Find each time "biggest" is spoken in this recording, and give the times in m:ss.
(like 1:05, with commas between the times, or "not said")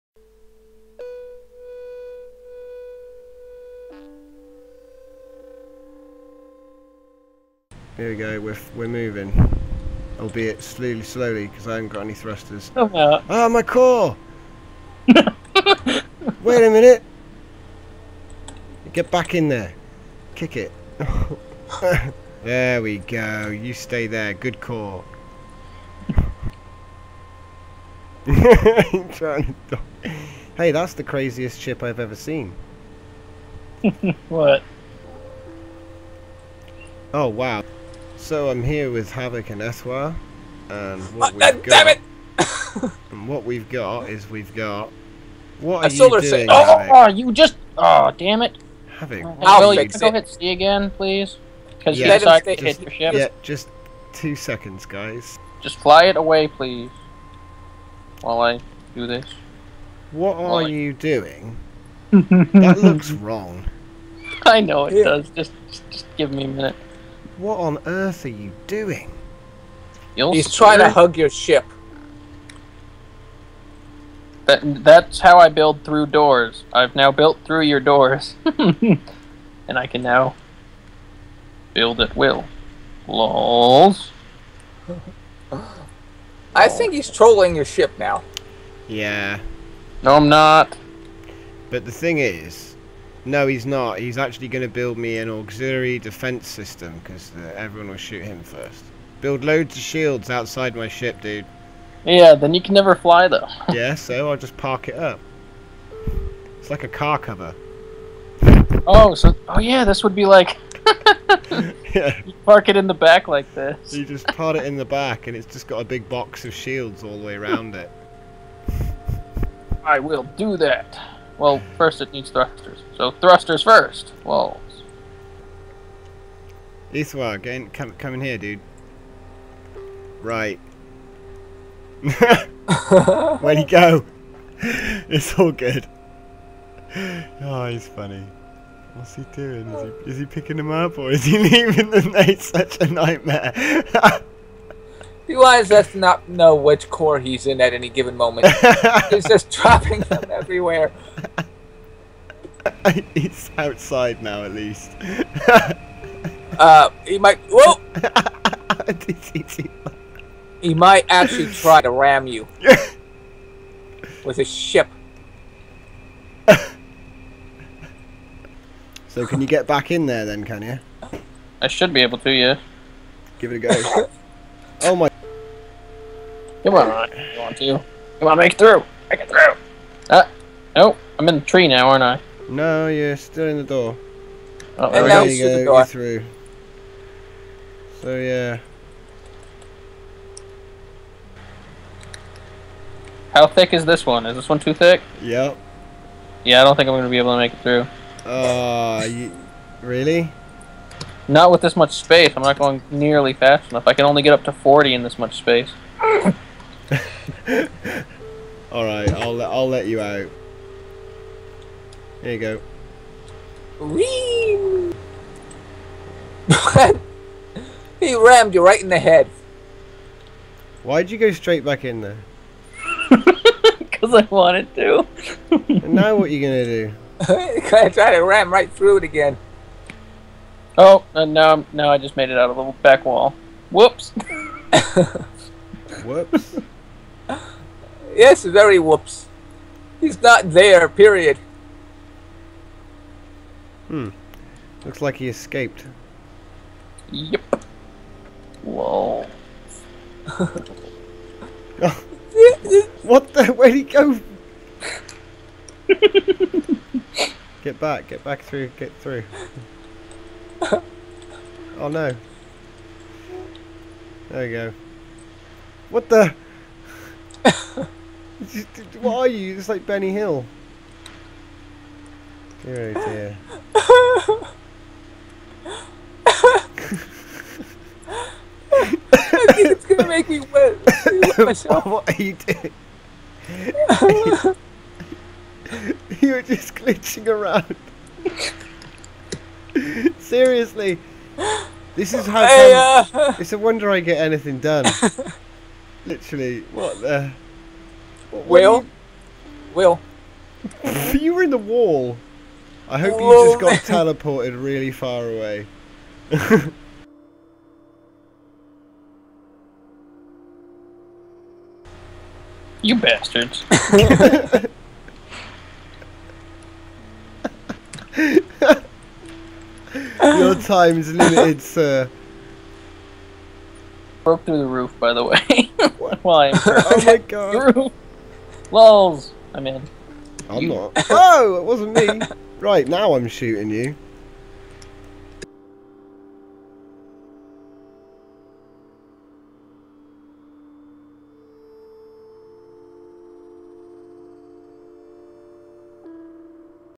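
not said.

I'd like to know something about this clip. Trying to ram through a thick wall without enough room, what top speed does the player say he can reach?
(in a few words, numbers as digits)
40.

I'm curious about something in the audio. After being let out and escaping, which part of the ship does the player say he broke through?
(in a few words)
The roof.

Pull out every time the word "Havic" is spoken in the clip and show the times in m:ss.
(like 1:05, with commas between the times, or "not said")
0:39, 0:48.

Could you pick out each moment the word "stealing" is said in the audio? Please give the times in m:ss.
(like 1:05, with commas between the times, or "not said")
not said.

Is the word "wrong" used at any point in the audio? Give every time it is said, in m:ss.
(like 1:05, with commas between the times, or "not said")
1:03.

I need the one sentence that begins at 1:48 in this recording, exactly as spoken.
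Oh, so oh yeah, this would be like.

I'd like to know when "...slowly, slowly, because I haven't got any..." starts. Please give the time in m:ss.
0:10.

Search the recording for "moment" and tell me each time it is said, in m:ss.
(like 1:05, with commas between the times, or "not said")
2:28.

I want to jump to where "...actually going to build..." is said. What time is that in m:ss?
1:34.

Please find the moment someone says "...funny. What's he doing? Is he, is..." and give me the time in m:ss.
2:17.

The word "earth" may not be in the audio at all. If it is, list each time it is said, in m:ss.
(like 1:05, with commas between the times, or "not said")
1:07.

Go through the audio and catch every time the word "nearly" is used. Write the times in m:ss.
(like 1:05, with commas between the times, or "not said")
3:22.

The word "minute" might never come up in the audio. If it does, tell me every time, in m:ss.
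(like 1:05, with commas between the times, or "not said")
0:16, 1:06.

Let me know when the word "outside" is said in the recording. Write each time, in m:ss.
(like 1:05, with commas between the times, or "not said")
1:40, 2:33.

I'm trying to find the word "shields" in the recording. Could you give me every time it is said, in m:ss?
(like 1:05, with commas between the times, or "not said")
1:39, 1:56.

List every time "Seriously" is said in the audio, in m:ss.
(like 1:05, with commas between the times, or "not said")
4:50.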